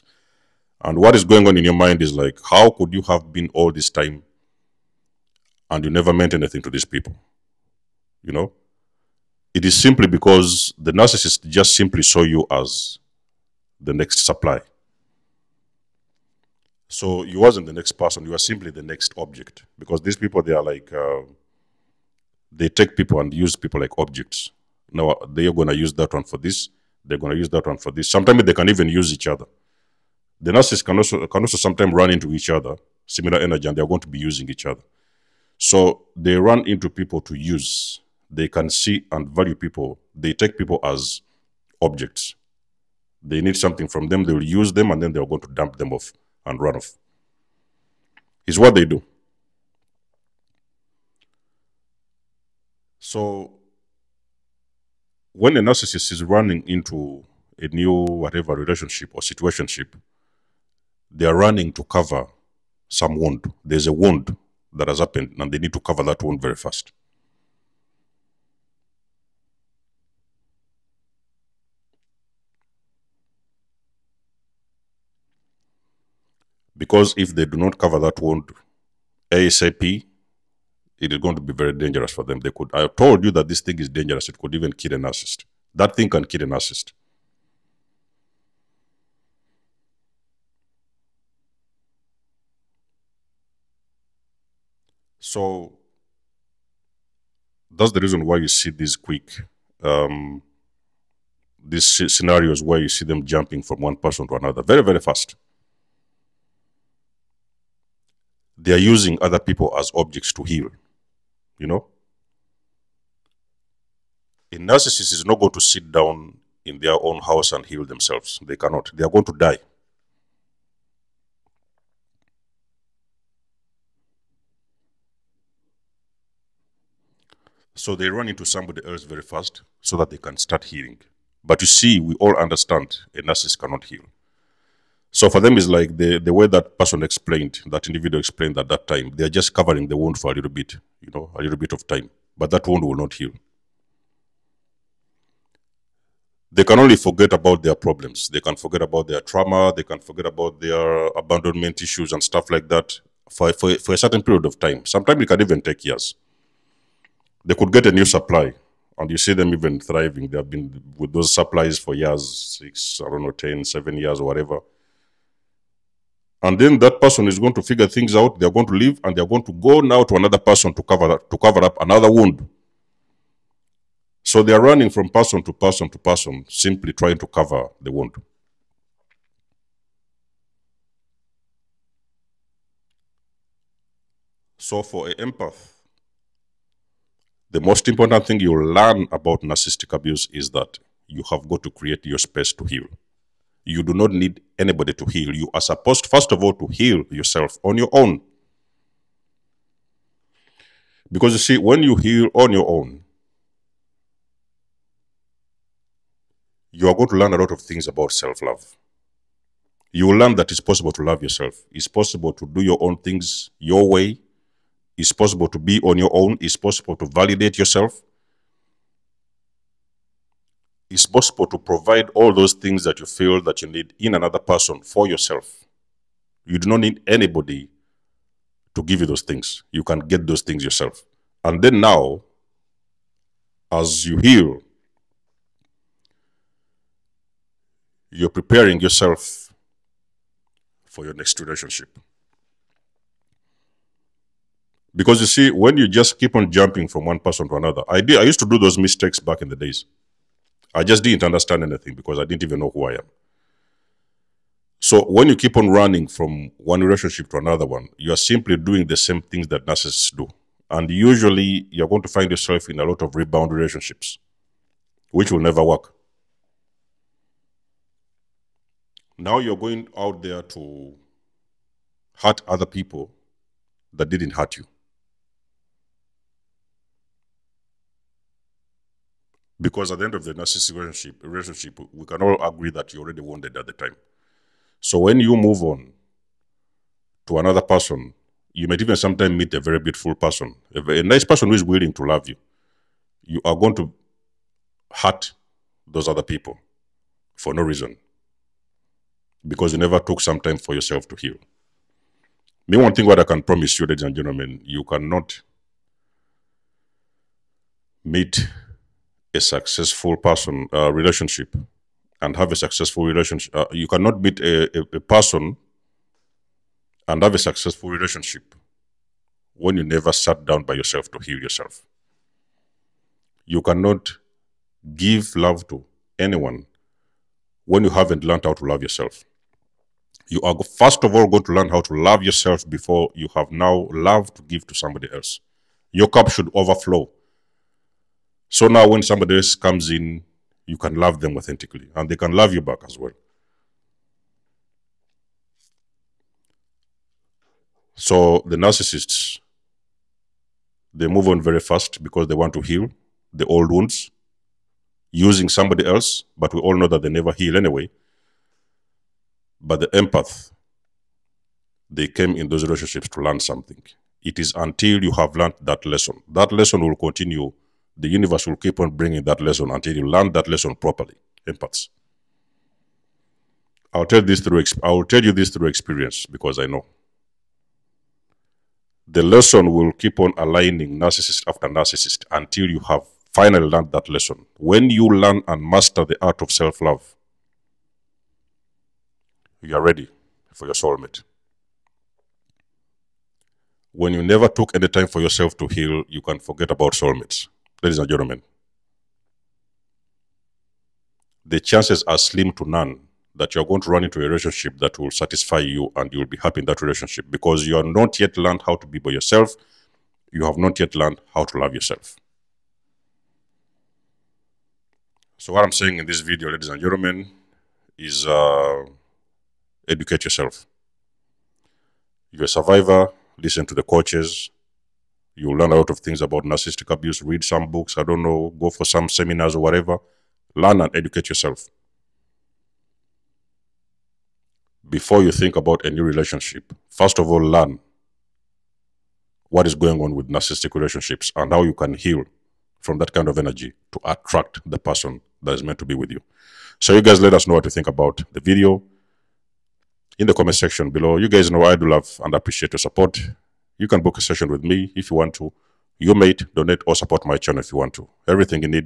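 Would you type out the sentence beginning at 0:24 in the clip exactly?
Now they are going to use that one for this, they're going to use that one for this.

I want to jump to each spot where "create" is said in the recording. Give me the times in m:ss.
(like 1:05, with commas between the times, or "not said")
3:11.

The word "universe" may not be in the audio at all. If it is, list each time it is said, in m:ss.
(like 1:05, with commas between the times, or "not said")
6:08.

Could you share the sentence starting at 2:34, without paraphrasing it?
Sometimes it can even take years.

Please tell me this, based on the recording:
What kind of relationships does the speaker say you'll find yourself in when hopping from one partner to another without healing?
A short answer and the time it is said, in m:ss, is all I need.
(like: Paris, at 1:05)
rebound relationships, at 4:23.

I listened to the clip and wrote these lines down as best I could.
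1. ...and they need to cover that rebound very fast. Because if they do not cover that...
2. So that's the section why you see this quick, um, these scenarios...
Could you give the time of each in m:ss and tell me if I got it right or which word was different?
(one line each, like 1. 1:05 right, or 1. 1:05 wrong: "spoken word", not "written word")
1. 1:05 wrong: "wound", not "rebound"
2. 1:35 wrong: "reason", not "section".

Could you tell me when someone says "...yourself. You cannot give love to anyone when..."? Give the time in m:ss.
5:21.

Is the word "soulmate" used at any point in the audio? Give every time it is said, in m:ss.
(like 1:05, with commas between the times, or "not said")
6:30, 6:36.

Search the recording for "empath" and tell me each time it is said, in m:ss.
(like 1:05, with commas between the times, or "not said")
3:05, 5:59, 6:11.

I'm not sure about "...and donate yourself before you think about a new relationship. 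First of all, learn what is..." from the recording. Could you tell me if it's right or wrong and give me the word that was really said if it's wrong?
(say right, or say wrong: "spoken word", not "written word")
wrong: "educate", not "donate".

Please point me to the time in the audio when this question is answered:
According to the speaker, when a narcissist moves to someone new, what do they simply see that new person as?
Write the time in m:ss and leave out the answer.
0:13.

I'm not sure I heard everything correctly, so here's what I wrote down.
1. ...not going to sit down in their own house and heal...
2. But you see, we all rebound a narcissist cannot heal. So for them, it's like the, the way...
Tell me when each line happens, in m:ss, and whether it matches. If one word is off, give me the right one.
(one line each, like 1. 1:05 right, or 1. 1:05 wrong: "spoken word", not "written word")
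1. 1:55 right
2. 2:11 wrong: "understand", not "rebound".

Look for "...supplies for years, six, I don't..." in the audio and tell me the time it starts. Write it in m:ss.
2:41.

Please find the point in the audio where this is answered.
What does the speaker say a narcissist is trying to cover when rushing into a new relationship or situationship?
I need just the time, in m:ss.
1:01.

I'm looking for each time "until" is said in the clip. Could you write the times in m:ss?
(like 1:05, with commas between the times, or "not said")
6:04, 6:09, 6:22.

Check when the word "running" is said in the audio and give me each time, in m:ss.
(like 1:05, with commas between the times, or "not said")
0:56, 1:01, 2:54, 4:15.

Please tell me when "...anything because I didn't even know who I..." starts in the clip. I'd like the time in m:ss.
4:11.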